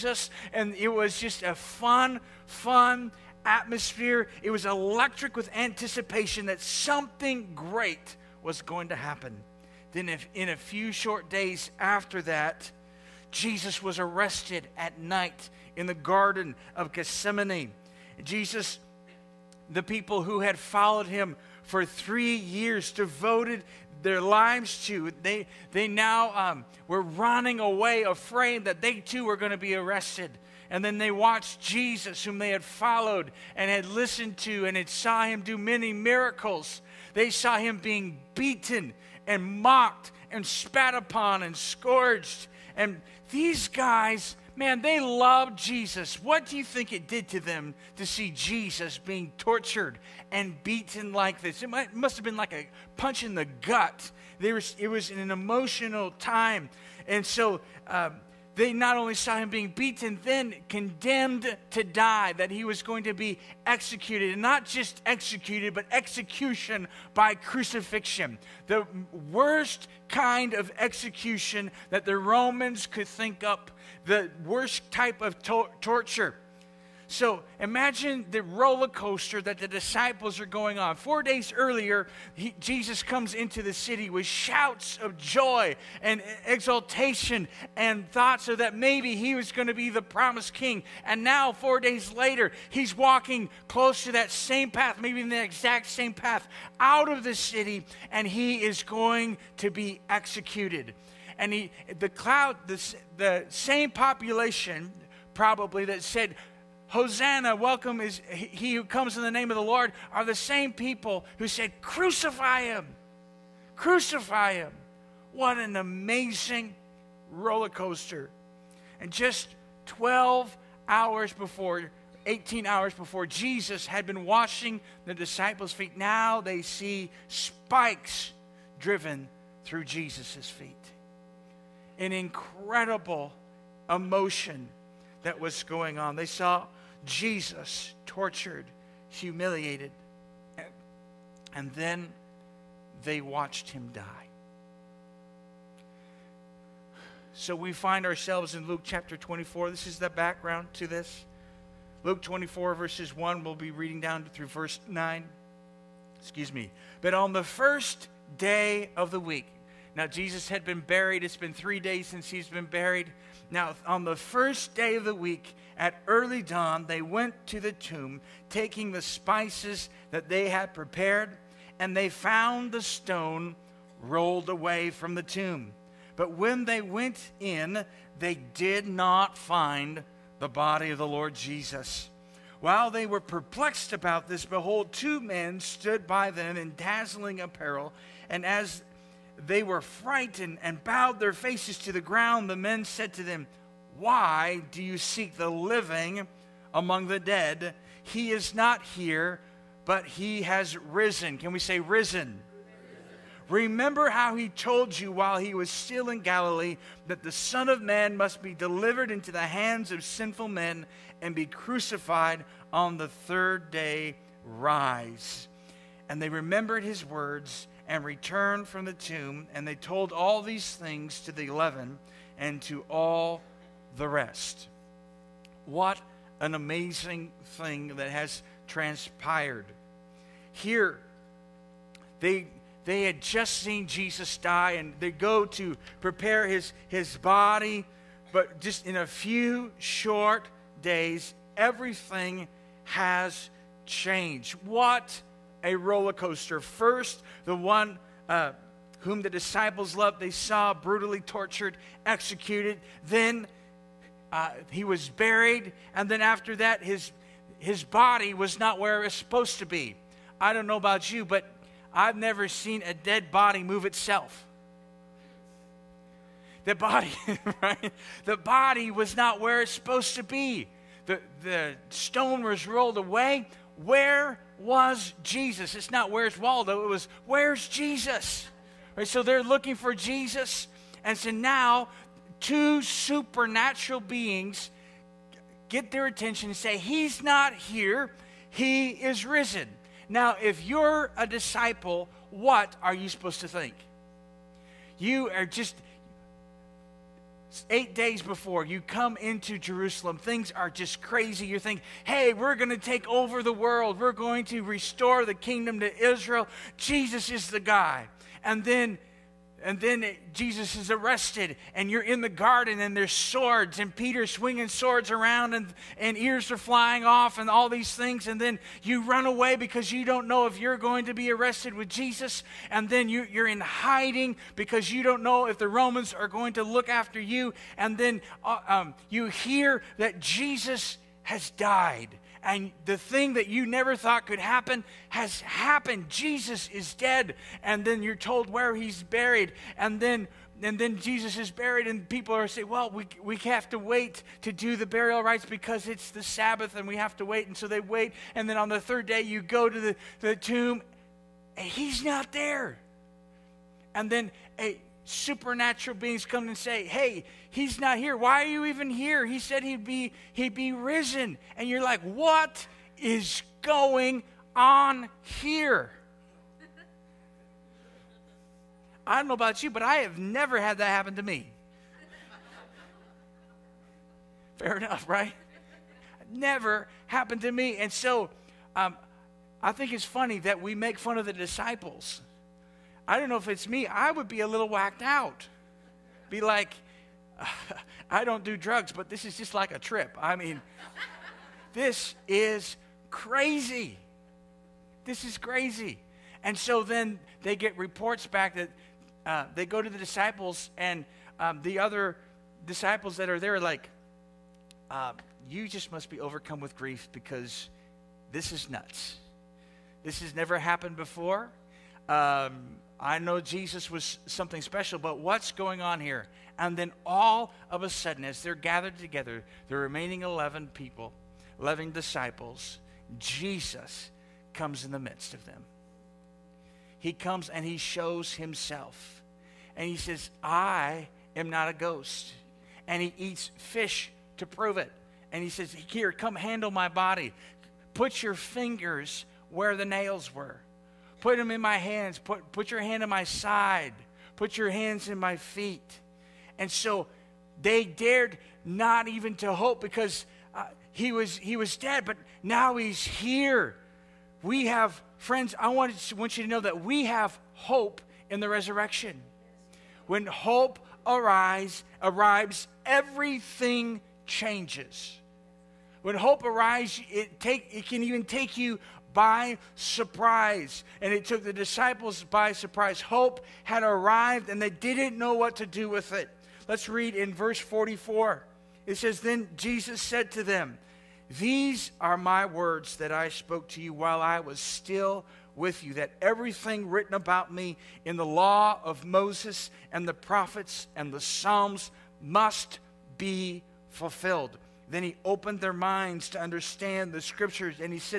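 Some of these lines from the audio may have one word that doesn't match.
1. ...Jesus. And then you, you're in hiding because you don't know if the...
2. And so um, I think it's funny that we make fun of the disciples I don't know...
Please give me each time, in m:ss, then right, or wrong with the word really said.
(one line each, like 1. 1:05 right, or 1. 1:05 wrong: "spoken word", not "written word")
1. 5:21 right
2. 6:17 right.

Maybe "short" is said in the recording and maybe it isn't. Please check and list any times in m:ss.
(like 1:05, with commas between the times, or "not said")
0:10, 3:59.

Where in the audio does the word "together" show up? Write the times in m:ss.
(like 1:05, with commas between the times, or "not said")
6:58.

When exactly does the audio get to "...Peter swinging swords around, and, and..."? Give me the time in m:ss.
5:13.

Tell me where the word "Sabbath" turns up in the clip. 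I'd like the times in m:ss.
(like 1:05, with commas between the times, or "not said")
5:46.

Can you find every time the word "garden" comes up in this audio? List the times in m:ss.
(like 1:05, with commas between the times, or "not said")
0:15, 5:12.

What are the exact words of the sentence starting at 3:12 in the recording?
The men said to them, Why do you seek the living among the dead?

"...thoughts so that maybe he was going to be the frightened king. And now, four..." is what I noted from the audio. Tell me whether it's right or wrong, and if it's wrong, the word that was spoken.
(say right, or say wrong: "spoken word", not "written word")
wrong: "promised", not "frightened".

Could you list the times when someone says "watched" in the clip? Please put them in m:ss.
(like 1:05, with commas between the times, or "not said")
0:31, 2:23.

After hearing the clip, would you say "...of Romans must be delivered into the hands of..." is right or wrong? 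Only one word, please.
wrong.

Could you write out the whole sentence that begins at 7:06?
He comes and he shows himself.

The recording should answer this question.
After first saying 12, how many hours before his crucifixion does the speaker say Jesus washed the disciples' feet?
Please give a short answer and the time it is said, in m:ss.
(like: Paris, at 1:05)
18, at 2:02.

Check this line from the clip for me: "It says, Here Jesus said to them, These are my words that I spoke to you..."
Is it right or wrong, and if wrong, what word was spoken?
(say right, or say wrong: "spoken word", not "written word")
wrong: "Then", not "Here".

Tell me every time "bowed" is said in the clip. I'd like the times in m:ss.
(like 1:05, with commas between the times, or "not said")
3:10.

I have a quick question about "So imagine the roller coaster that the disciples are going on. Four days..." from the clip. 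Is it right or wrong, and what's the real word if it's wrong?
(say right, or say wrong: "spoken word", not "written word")
right.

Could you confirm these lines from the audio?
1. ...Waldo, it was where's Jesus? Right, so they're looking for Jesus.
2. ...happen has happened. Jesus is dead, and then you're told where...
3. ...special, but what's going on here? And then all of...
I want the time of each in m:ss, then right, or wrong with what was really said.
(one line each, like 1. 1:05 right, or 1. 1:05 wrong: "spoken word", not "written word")
1. 4:36 right
2. 5:34 right
3. 6:54 right.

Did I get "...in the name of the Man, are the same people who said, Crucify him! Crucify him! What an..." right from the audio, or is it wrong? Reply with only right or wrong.
wrong.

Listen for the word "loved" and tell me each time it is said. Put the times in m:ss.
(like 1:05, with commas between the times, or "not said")
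0:44, 4:09.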